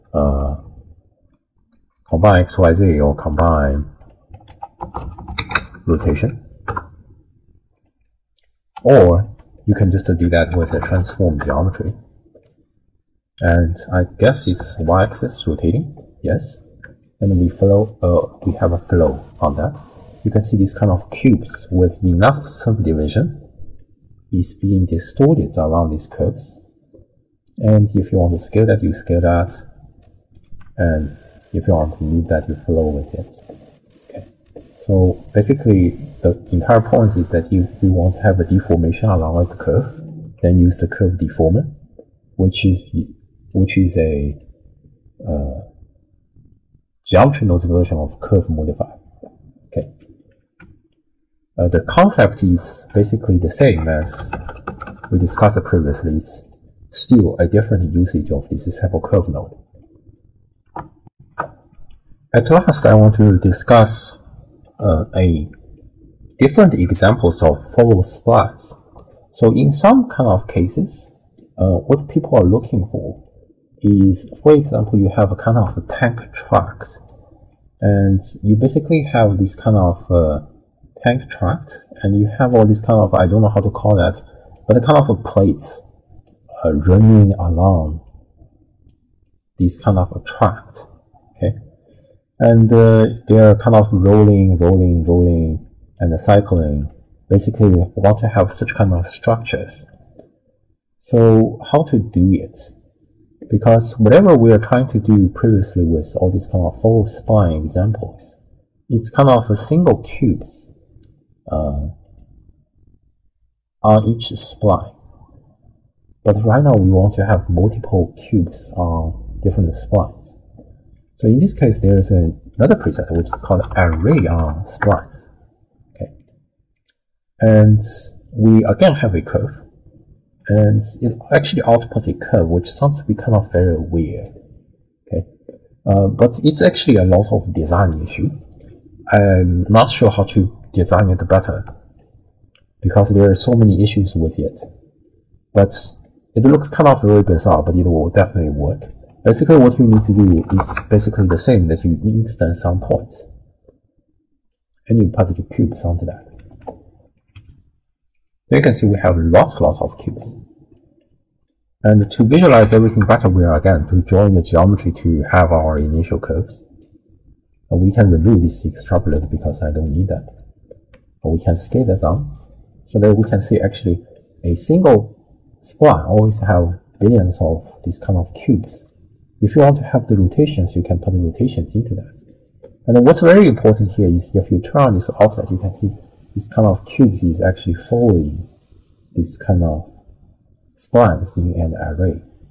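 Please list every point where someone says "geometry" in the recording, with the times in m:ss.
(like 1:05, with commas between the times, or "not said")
0:11, 0:47, 2:44.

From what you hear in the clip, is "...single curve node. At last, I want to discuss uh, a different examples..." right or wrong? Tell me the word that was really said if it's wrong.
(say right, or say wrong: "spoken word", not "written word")
wrong: "sample", not "single".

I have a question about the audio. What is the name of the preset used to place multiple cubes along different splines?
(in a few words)
Array on splines.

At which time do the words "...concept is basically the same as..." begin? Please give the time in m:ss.
0:51.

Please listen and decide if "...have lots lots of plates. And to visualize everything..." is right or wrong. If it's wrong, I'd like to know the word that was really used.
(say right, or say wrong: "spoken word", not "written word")
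wrong: "cubes", not "plates".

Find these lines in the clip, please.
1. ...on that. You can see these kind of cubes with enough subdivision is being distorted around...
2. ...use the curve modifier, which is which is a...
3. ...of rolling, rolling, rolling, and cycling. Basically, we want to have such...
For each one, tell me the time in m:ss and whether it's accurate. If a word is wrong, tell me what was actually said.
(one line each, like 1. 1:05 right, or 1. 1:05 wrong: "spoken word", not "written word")
1. 0:19 right
2. 0:40 wrong: "deformer", not "modifier"
3. 1:33 right.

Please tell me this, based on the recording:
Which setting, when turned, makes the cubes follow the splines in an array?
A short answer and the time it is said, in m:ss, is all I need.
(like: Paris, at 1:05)
Offset, at 3:05.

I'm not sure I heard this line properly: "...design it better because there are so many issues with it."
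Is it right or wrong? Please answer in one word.
right.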